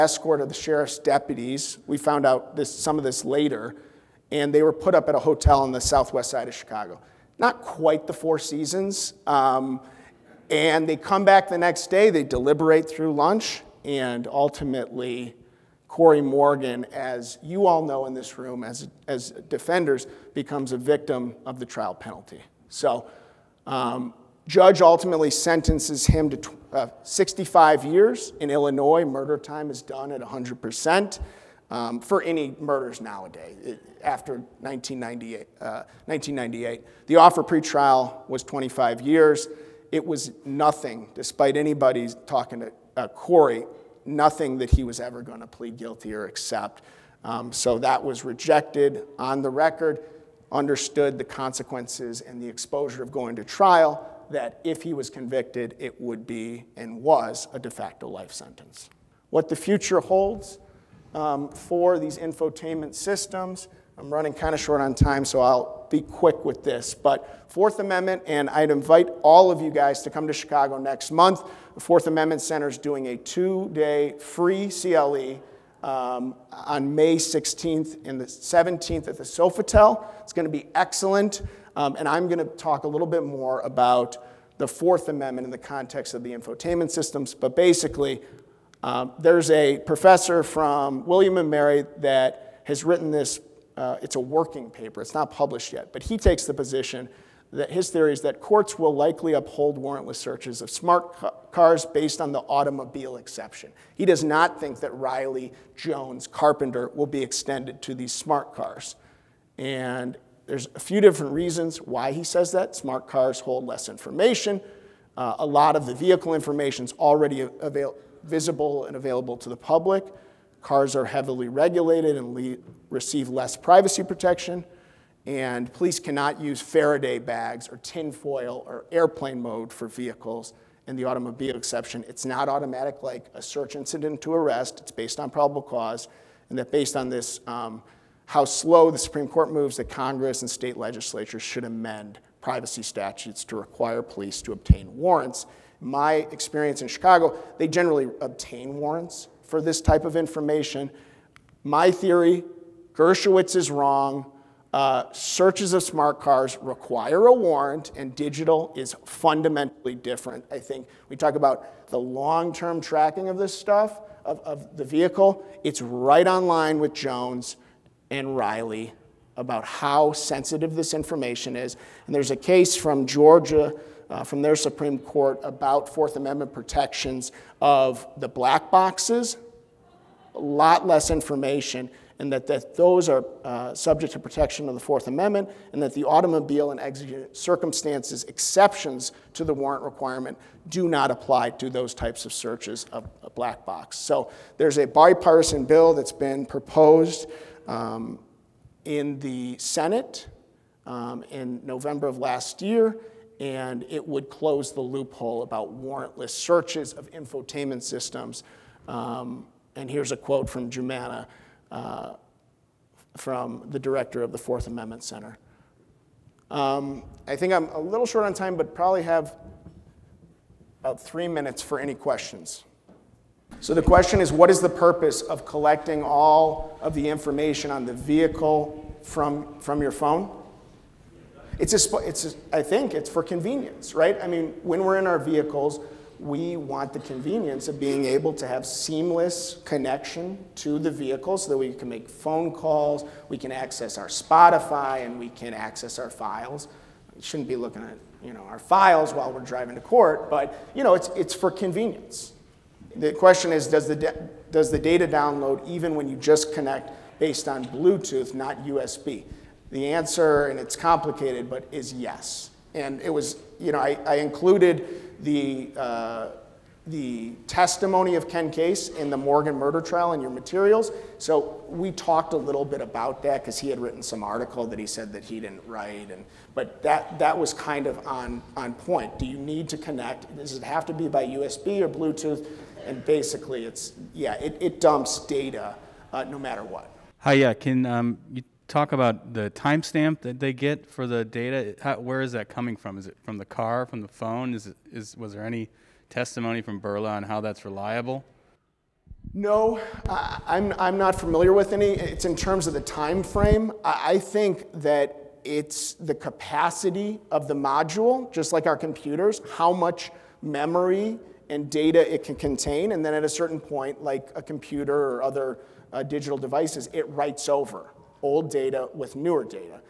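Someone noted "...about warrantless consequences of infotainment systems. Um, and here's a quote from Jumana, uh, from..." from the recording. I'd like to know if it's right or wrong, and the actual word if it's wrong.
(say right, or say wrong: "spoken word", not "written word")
wrong: "searches", not "consequences".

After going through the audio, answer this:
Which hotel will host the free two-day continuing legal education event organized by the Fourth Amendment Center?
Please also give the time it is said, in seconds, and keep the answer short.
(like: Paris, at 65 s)
Sofitel, at 79 s.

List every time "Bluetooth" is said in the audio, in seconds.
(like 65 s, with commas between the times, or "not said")
257 s, 281 s.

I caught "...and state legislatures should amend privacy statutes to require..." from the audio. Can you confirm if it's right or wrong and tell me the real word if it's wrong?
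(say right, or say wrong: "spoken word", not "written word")
right.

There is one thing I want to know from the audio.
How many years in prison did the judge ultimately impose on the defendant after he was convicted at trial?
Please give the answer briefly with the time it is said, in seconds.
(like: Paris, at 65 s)
65 years, at 27 s.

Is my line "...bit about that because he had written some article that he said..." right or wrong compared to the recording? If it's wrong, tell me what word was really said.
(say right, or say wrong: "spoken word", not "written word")
right.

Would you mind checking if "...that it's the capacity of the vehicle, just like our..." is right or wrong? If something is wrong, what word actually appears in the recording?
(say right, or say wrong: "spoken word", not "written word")
wrong: "module", not "vehicle".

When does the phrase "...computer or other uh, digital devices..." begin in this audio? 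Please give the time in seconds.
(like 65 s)
314 s.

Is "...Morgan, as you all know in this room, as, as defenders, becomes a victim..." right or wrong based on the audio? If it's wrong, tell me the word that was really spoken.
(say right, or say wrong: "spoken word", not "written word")
right.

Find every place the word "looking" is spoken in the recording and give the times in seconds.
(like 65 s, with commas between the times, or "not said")
247 s.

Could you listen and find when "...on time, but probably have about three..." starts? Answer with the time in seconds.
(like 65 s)
218 s.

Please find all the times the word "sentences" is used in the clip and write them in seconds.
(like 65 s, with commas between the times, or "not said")
25 s, 58 s.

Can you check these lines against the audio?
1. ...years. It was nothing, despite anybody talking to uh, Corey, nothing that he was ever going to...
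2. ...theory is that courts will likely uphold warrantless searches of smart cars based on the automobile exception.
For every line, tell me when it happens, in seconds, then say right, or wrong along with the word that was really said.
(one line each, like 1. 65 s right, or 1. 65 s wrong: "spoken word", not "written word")
1. 39 s right
2. 97 s right.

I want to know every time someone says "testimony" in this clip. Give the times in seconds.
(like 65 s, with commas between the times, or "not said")
267 s, 296 s.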